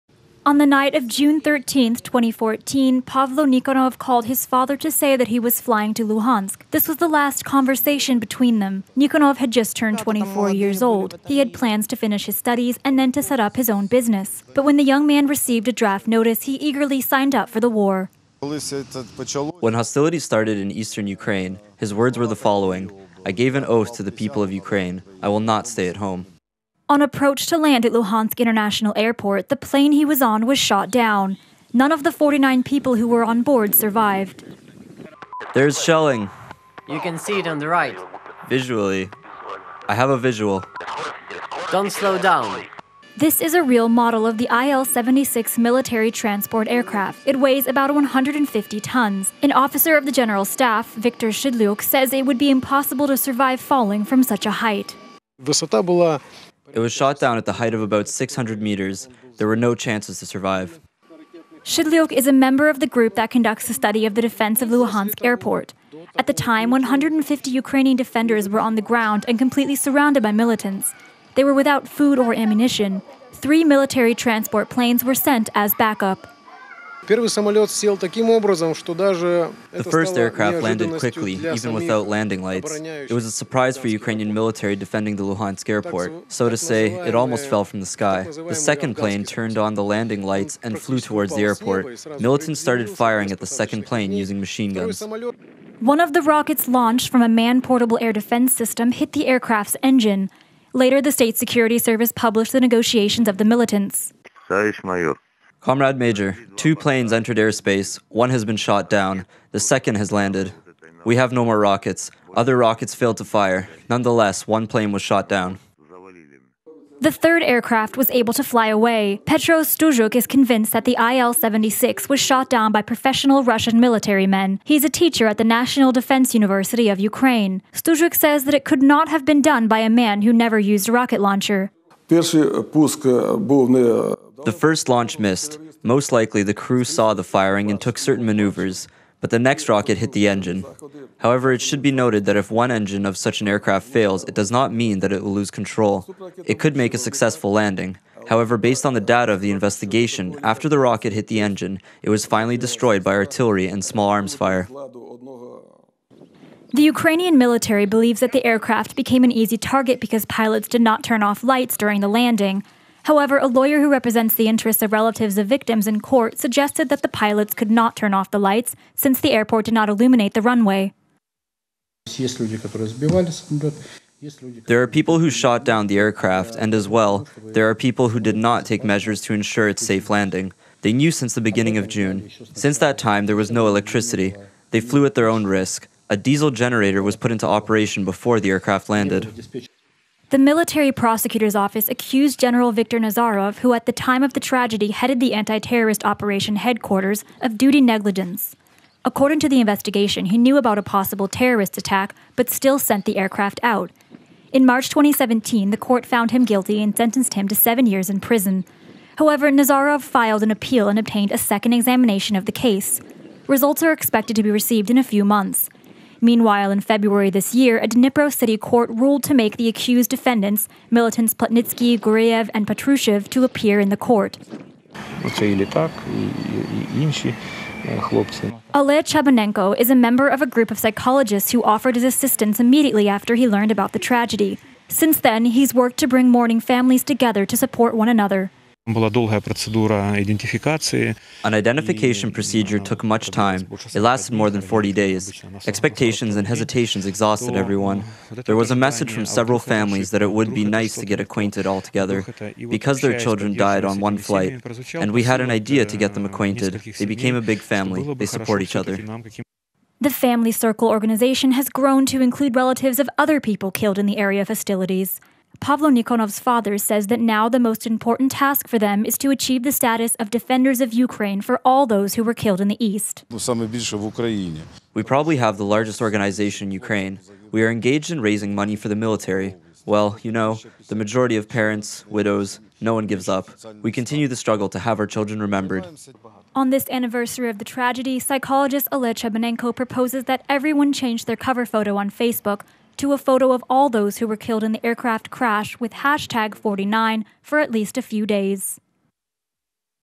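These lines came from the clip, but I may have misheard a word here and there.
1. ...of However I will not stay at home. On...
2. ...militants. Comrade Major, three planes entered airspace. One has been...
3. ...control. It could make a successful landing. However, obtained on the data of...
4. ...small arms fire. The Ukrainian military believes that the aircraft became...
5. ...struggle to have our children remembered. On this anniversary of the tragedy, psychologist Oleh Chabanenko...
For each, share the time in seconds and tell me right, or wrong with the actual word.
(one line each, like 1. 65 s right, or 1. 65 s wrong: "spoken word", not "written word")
1. 24 s wrong: "Ukraine", not "However"
2. 103 s wrong: "two", not "three"
3. 145 s wrong: "based", not "obtained"
4. 153 s right
5. 284 s right.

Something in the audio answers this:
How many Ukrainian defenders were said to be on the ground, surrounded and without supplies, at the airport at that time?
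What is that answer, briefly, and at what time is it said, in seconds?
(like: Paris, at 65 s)
150, at 66 s.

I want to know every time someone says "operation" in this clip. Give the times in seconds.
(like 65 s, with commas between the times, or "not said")
187 s, 196 s.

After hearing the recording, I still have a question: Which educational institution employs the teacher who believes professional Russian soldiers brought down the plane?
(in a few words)
National Defense University of Ukraine.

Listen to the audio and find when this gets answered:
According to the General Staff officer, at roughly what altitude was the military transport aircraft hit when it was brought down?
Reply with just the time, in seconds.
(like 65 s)
58 s.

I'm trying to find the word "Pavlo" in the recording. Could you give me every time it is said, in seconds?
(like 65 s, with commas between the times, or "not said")
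3 s, 265 s.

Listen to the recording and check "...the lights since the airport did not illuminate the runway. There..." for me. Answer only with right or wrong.
right.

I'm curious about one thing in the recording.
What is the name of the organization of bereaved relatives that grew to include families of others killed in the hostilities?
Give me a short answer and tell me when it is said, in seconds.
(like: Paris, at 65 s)
Family Circle, at 260 s.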